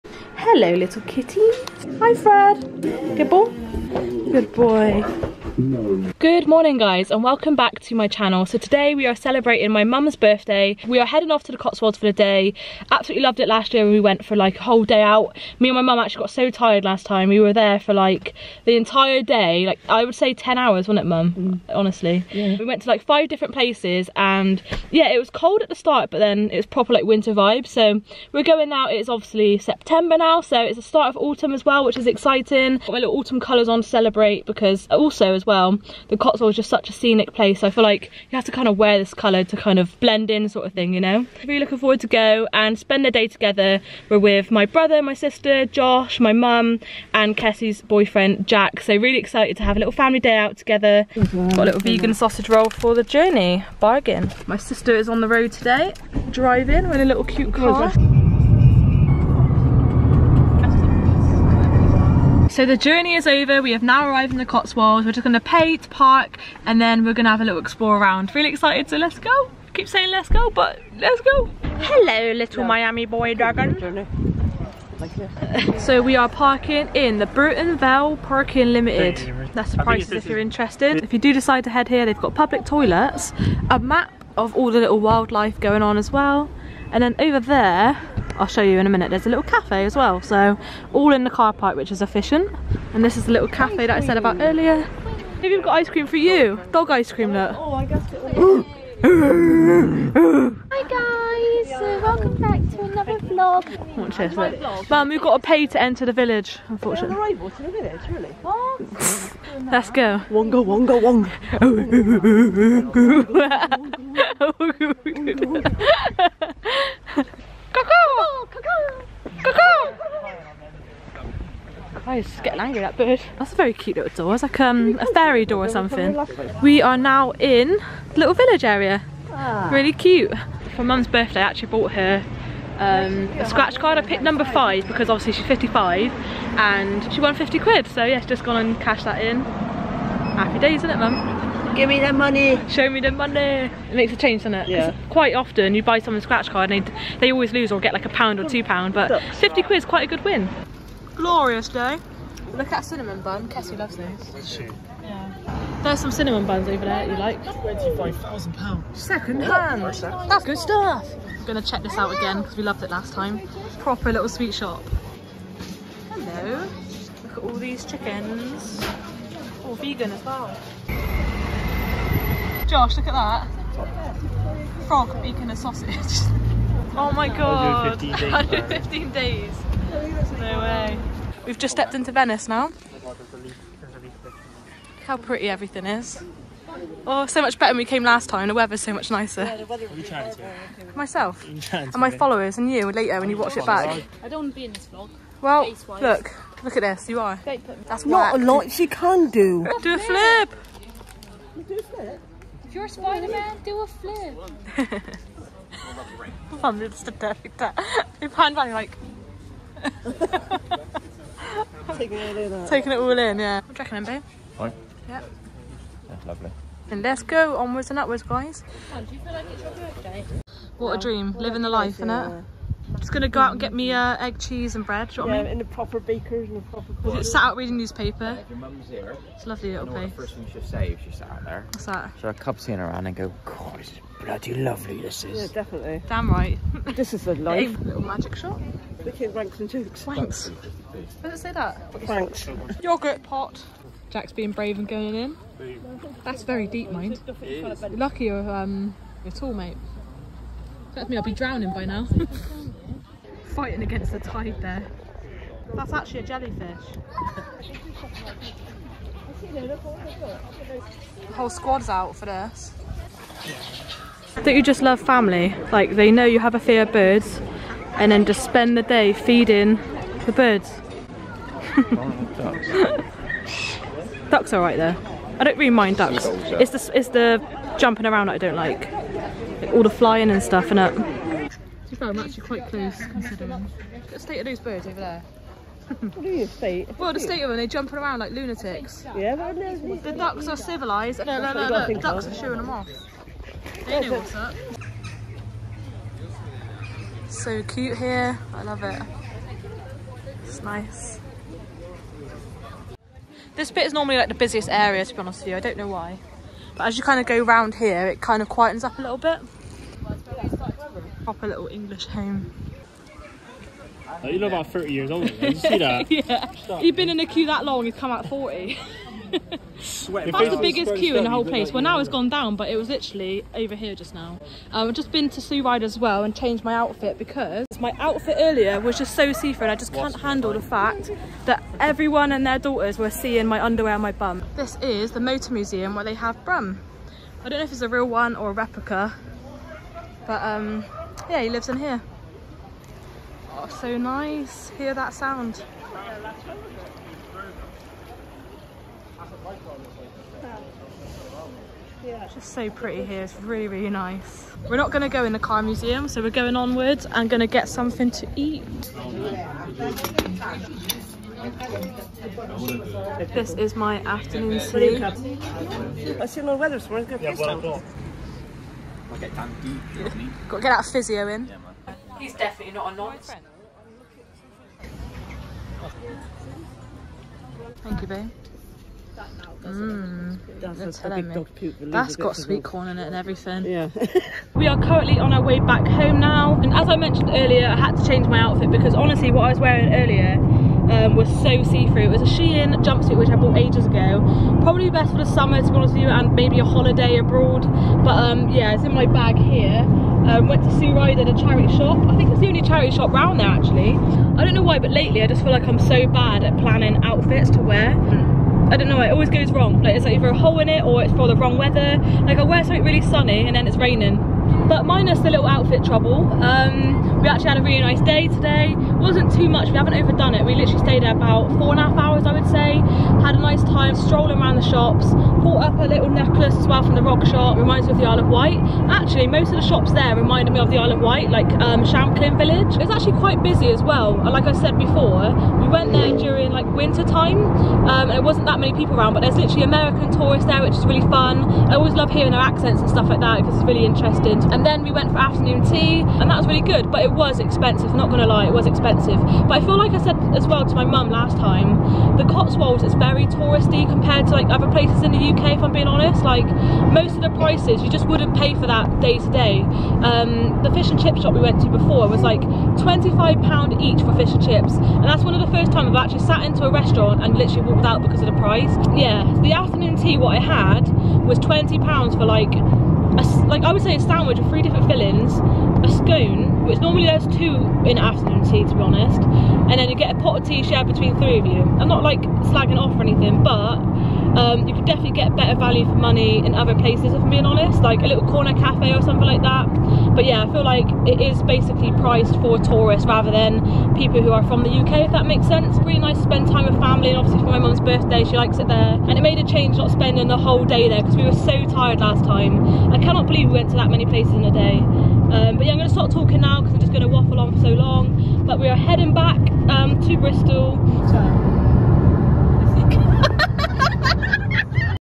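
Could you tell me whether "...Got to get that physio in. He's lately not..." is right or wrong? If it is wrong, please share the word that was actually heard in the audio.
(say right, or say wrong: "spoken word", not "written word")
wrong: "definitely", not "lately".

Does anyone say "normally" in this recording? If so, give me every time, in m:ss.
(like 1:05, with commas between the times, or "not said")
5:03, 7:56.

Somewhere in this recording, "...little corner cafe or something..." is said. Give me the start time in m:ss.
8:08.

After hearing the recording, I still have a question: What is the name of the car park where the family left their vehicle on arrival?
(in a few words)
Bourton Vale Parking Limited.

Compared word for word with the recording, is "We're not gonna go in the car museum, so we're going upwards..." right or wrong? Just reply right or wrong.
wrong.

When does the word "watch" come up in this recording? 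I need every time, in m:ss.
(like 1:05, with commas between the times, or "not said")
1:43, 3:13.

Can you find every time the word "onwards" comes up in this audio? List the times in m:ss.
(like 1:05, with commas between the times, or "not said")
3:37, 5:56.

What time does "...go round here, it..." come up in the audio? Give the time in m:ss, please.
5:07.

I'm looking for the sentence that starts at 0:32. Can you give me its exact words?
Got my little autumn colours on to celebrate because also as well.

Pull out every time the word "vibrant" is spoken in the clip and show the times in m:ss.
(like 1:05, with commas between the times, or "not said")
not said.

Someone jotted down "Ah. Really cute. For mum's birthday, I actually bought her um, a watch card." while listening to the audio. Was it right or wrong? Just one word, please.
wrong.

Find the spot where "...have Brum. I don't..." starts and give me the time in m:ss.
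5:36.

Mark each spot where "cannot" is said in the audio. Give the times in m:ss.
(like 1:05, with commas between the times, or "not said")
8:22.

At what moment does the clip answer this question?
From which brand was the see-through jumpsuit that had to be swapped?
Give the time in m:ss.
6:32.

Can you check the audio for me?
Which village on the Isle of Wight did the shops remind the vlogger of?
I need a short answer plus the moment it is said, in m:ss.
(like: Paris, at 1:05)
Shanklin Village, at 7:11.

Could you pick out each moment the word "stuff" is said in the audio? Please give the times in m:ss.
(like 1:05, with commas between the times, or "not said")
2:40, 4:40, 7:22.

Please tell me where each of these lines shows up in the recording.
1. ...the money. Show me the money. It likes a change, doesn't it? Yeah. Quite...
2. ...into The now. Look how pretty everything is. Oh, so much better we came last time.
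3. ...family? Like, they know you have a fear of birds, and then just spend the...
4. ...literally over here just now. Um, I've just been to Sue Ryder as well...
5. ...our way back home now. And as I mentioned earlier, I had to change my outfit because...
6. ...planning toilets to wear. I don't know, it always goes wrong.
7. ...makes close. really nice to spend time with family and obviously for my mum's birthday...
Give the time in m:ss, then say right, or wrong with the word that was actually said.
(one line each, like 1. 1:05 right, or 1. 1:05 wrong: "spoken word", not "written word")
1. 2:22 wrong: "makes", not "likes"
2. 3:01 wrong: "Venice", not "The"
3. 4:24 right
4. 5:22 right
5. 6:25 right
6. 6:46 wrong: "outfits", not "toilets"
7. 8:15 wrong: "sense", not "close".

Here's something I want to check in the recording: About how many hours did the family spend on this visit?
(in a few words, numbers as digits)
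4 and a half hours.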